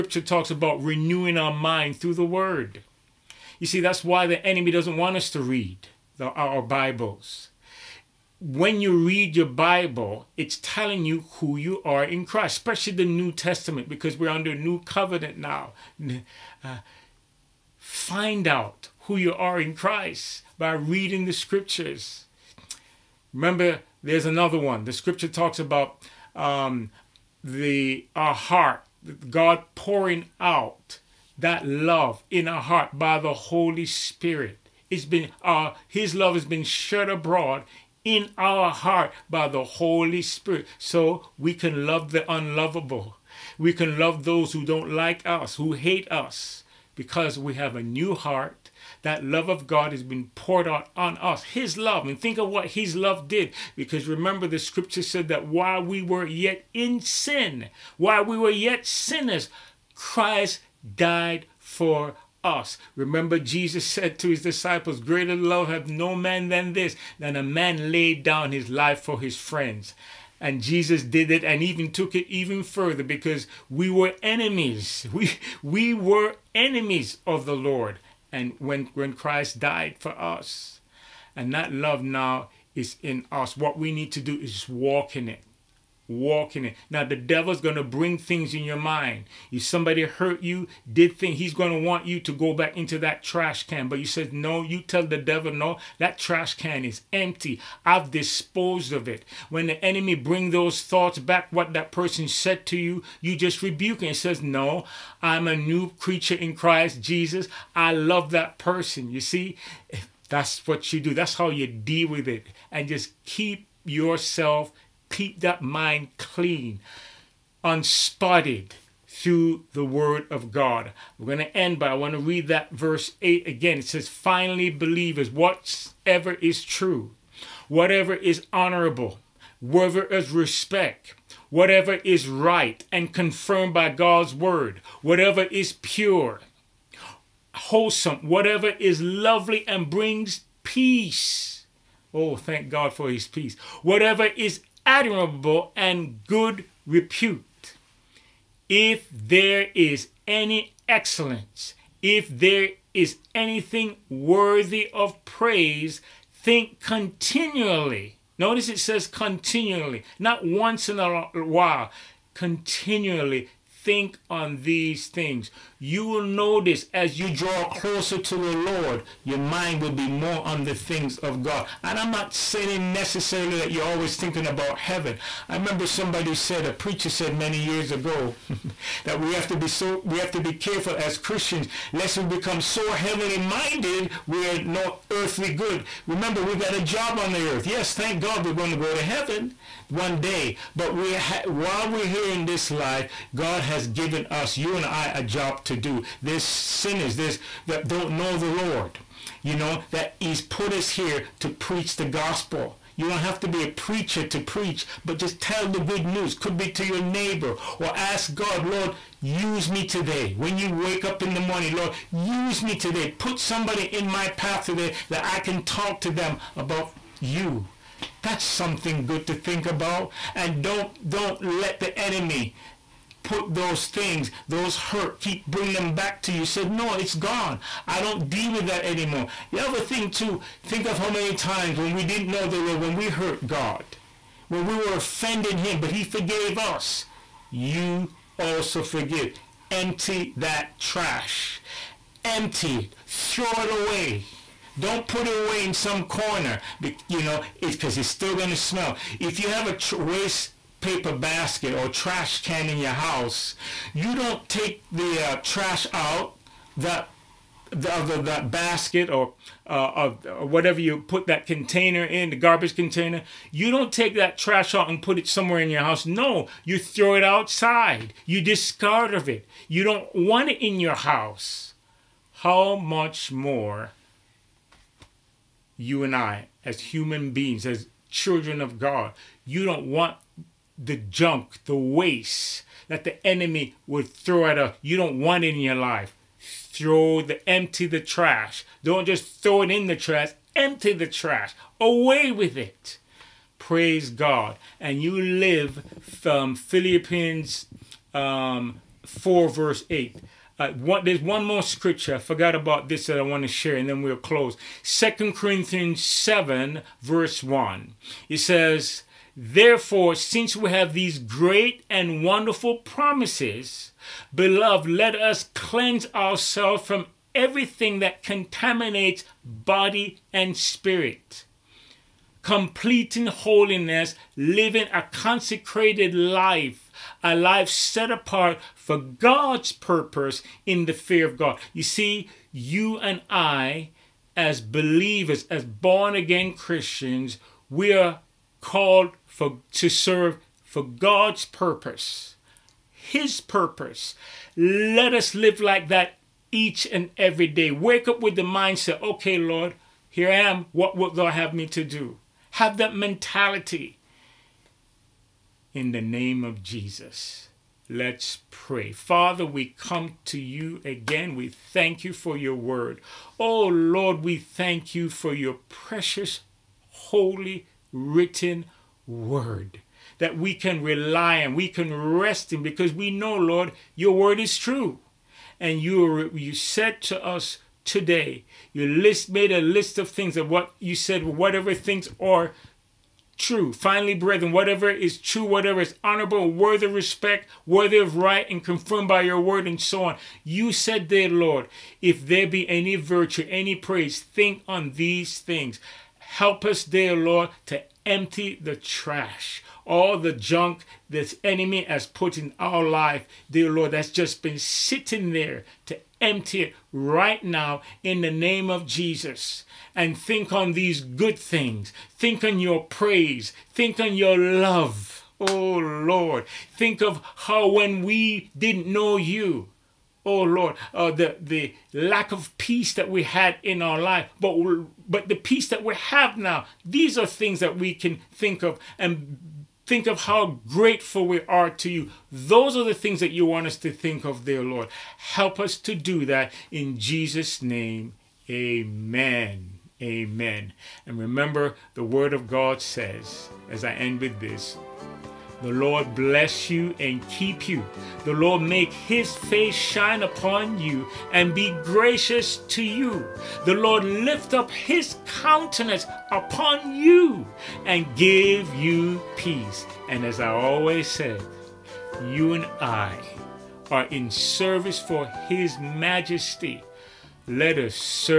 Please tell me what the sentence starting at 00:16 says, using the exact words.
Uh, find out who you are in Christ by reading the scriptures.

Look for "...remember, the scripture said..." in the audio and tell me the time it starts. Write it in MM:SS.
00:54.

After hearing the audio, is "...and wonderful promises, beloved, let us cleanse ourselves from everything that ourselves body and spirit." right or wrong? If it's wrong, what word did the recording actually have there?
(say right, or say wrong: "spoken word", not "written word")
wrong: "contaminates", not "ourselves".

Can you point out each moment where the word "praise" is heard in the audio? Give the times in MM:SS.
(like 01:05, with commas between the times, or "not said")
02:35, 04:53, 06:33, 06:52.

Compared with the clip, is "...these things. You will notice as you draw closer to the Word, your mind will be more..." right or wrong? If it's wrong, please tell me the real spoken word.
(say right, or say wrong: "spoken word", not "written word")
wrong: "Lord", not "Word".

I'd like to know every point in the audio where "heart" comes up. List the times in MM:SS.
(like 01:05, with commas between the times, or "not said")
00:28, 00:32, 00:38, 00:48.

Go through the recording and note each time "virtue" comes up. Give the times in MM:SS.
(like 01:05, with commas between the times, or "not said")
06:32.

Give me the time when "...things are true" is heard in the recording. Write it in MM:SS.
06:21.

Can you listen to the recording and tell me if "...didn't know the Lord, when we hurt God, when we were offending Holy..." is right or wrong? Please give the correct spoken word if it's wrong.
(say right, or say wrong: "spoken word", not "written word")
wrong: "Him", not "Holy".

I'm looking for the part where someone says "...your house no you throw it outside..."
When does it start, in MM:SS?
04:25.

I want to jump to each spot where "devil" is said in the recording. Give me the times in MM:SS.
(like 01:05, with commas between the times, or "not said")
01:27, 01:35.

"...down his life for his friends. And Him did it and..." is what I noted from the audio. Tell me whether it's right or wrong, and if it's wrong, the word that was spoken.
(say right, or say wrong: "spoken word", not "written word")
wrong: "Jesus", not "Him".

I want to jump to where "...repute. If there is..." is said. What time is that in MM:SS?
02:26.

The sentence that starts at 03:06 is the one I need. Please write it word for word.
Remember, we got a job on the earth.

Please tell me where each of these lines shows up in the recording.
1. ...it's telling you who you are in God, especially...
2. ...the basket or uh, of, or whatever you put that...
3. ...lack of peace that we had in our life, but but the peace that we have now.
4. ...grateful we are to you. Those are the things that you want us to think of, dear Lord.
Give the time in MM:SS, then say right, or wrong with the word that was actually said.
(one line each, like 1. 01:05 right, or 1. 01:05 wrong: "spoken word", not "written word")
1. 00:10 wrong: "Christ", not "God"
2. 04:18 right
3. 07:01 right
4. 07:10 right.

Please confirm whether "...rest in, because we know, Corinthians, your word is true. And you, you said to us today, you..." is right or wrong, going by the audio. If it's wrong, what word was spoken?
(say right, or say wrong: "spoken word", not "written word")
wrong: "Lord", not "Corinthians".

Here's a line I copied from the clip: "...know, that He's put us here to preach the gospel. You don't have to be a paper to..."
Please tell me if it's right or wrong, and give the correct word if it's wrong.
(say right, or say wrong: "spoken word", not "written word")
wrong: "preacher", not "paper".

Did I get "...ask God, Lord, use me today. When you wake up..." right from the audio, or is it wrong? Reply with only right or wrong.
right.